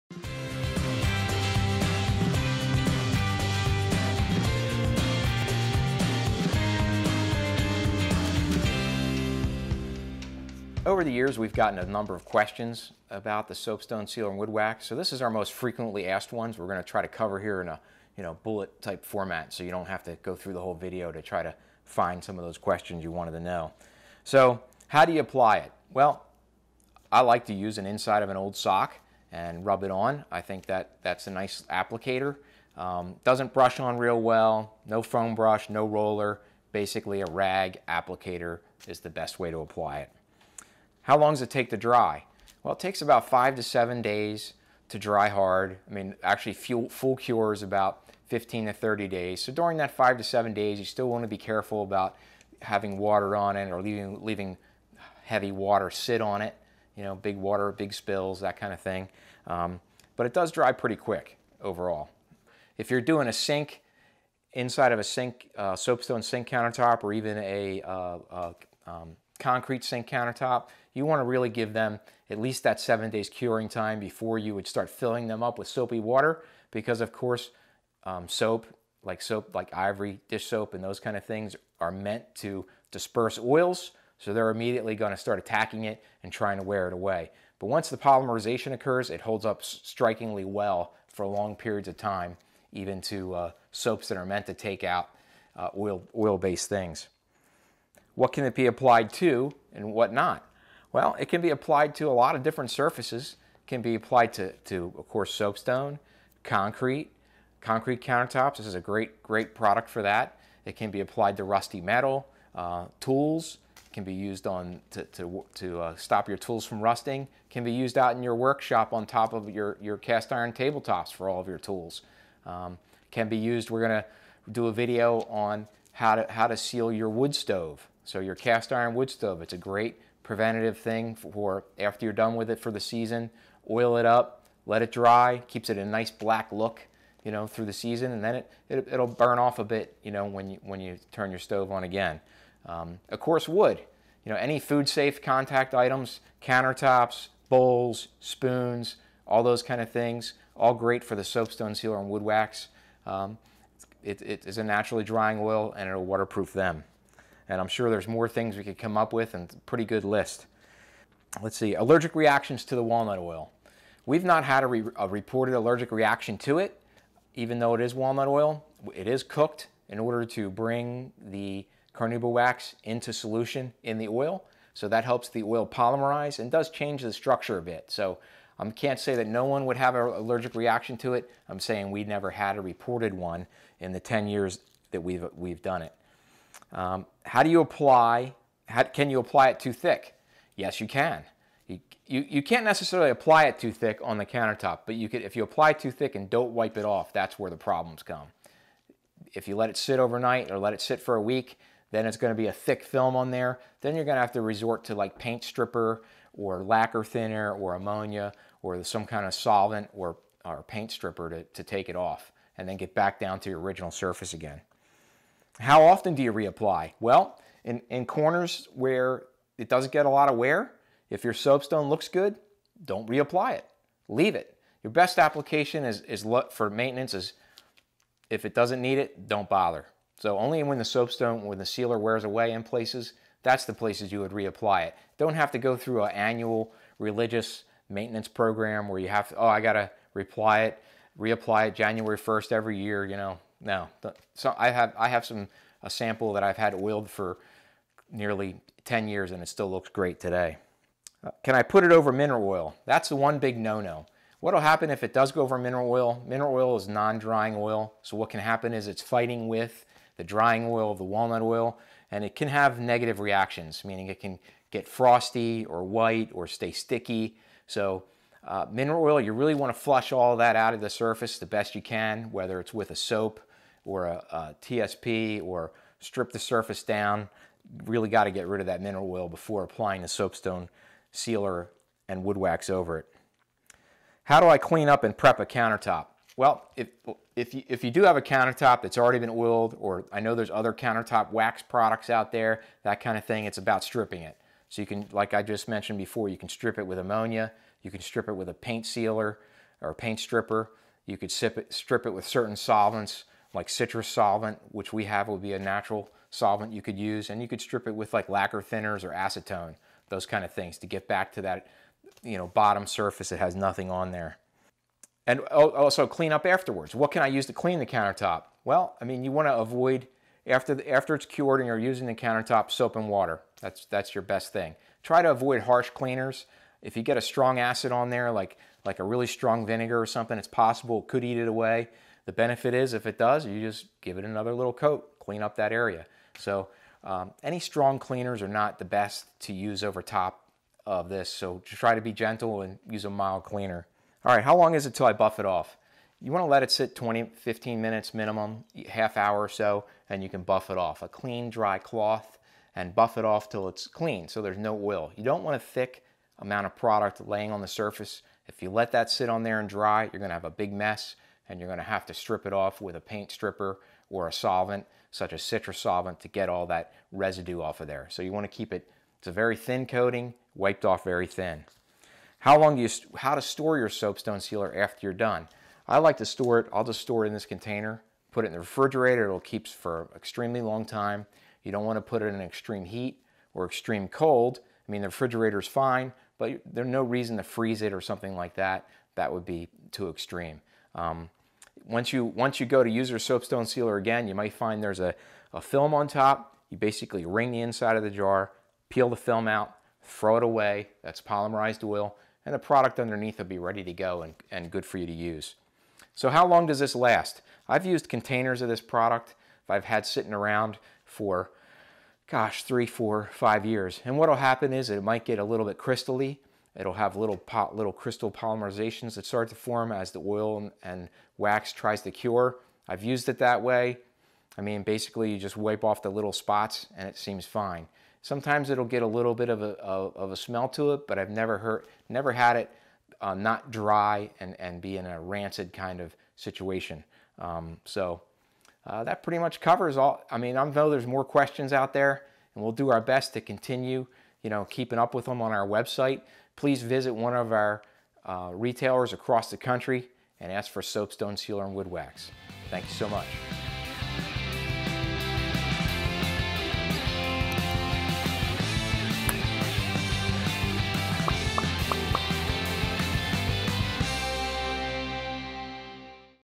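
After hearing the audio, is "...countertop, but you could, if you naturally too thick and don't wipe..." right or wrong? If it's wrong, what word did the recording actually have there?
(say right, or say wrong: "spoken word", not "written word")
wrong: "apply", not "naturally".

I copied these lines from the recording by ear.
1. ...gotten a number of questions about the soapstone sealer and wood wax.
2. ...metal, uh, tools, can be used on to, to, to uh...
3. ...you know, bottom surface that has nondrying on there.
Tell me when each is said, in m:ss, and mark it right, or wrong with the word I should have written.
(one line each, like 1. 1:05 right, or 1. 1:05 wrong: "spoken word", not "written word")
1. 0:11 right
2. 1:51 right
3. 5:12 wrong: "nothing", not "nondrying".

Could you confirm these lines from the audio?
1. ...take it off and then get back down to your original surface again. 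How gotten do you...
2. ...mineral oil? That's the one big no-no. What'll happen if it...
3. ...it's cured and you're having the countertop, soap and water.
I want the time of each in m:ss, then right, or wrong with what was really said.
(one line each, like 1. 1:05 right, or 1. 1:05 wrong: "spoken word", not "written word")
1. 3:31 wrong: "often", not "gotten"
2. 4:12 right
3. 5:21 wrong: "using", not "having".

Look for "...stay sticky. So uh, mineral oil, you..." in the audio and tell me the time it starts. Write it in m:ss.
4:26.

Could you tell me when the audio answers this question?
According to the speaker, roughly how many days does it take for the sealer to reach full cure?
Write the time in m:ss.
0:48.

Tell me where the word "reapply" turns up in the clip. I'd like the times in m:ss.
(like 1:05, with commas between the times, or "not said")
3:36, 3:43, 3:54, 4:01.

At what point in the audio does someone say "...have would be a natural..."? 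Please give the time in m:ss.
5:05.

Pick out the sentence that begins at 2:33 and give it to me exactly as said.
Um, it, it is a naturally drying oil and it'll waterproof them.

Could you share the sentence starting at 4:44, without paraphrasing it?
How do I clean up and prep a countertop?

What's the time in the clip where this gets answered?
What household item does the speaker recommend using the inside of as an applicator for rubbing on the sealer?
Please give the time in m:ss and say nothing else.
0:28.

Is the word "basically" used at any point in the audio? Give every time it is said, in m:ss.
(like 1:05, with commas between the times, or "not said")
0:36, 6:36, 7:04.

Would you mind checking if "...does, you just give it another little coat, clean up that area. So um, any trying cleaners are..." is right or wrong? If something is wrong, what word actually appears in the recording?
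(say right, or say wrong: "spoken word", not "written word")
wrong: "strong", not "trying".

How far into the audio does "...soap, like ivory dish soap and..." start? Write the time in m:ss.
1:19.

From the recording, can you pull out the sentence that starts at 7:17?
Um, so uh, that pretty much covers all.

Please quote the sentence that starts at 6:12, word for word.
How long do you, how to store your soapstone sealer after you're done?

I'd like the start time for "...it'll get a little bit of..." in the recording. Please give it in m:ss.
7:08.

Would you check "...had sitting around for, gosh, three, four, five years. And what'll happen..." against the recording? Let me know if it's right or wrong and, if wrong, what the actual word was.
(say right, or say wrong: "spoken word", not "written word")
right.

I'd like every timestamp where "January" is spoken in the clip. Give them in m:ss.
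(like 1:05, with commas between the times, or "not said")
4:01.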